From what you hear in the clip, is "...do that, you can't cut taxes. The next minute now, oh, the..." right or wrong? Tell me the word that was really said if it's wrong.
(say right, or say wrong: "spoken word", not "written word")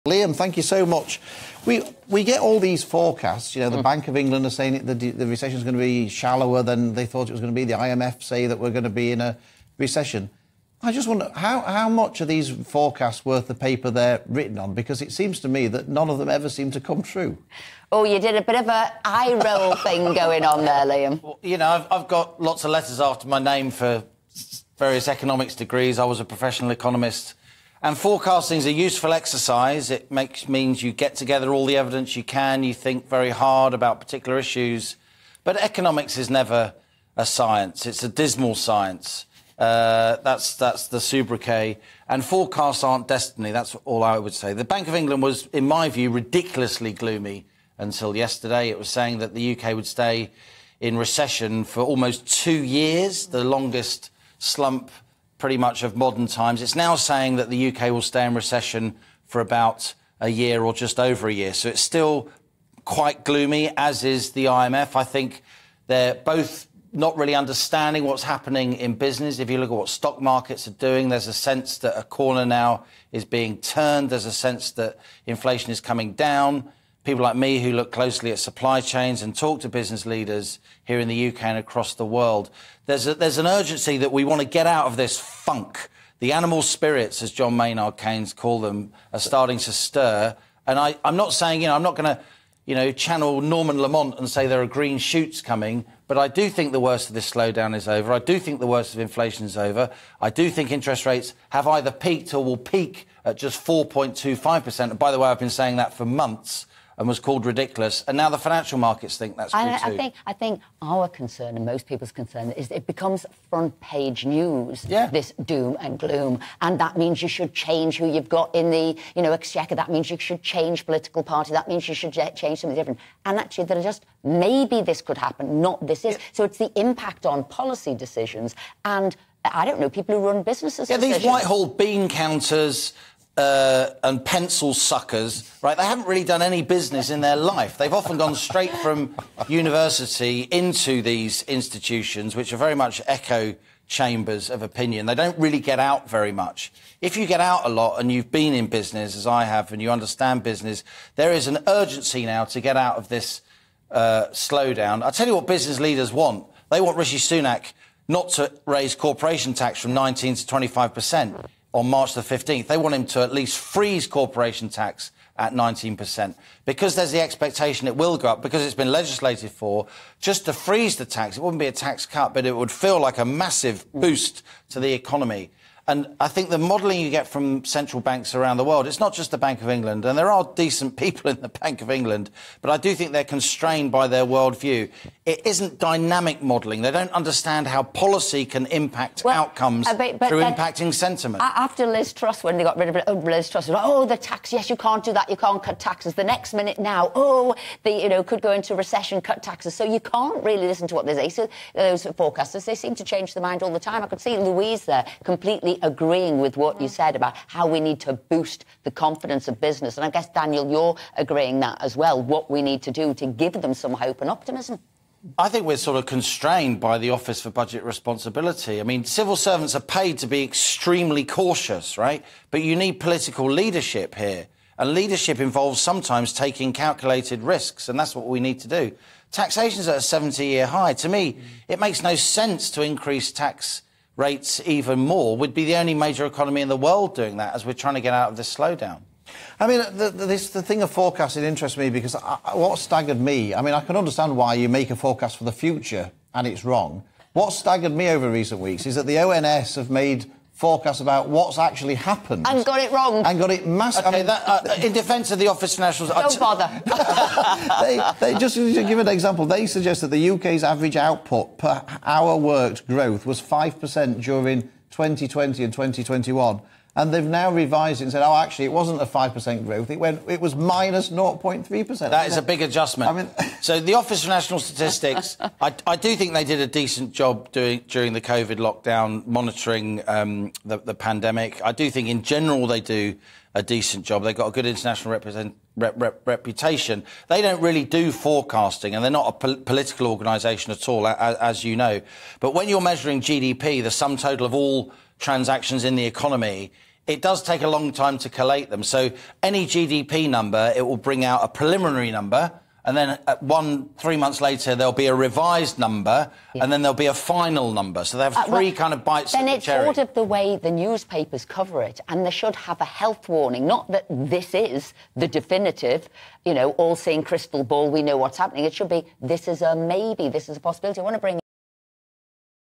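right.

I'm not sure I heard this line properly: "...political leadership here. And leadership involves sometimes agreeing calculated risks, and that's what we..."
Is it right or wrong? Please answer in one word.
wrong.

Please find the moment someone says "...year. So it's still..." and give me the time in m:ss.
1:01.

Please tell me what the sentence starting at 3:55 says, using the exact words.
We'd be the only major economy in the world doing that as we're trying to get out of this slowdown.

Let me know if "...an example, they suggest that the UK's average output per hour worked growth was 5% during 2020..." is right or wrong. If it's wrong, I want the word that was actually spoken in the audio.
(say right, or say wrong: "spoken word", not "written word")
right.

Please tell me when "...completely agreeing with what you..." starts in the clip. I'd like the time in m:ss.
3:25.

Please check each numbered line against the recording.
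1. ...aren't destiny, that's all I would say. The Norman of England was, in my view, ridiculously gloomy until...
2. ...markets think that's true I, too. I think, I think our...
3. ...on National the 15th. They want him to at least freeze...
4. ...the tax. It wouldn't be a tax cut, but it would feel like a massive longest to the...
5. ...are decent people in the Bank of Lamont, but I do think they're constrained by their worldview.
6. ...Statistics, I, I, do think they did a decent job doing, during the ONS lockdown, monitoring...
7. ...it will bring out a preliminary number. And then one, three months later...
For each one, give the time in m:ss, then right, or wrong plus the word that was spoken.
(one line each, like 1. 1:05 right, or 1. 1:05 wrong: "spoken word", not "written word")
1. 0:42 wrong: "Bank", not "Norman"
2. 1:48 right
3. 2:41 wrong: "March", not "National"
4. 2:50 wrong: "boost", not "longest"
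5. 3:00 wrong: "England", not "Lamont"
6. 4:34 wrong: "COVID", not "ONS"
7. 5:00 right.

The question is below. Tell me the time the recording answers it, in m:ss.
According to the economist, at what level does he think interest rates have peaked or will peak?
1:43.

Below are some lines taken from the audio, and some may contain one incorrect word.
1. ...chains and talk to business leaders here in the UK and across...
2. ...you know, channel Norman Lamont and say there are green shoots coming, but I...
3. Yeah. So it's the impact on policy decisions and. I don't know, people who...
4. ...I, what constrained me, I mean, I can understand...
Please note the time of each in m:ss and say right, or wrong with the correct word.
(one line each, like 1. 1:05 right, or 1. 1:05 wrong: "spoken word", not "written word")
1. 1:18 right
2. 1:32 right
3. 2:06 right
4. 4:02 wrong: "staggered", not "constrained".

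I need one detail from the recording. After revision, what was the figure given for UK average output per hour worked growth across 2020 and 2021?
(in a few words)
-0.3%.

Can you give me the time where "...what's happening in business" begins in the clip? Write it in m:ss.
1:08.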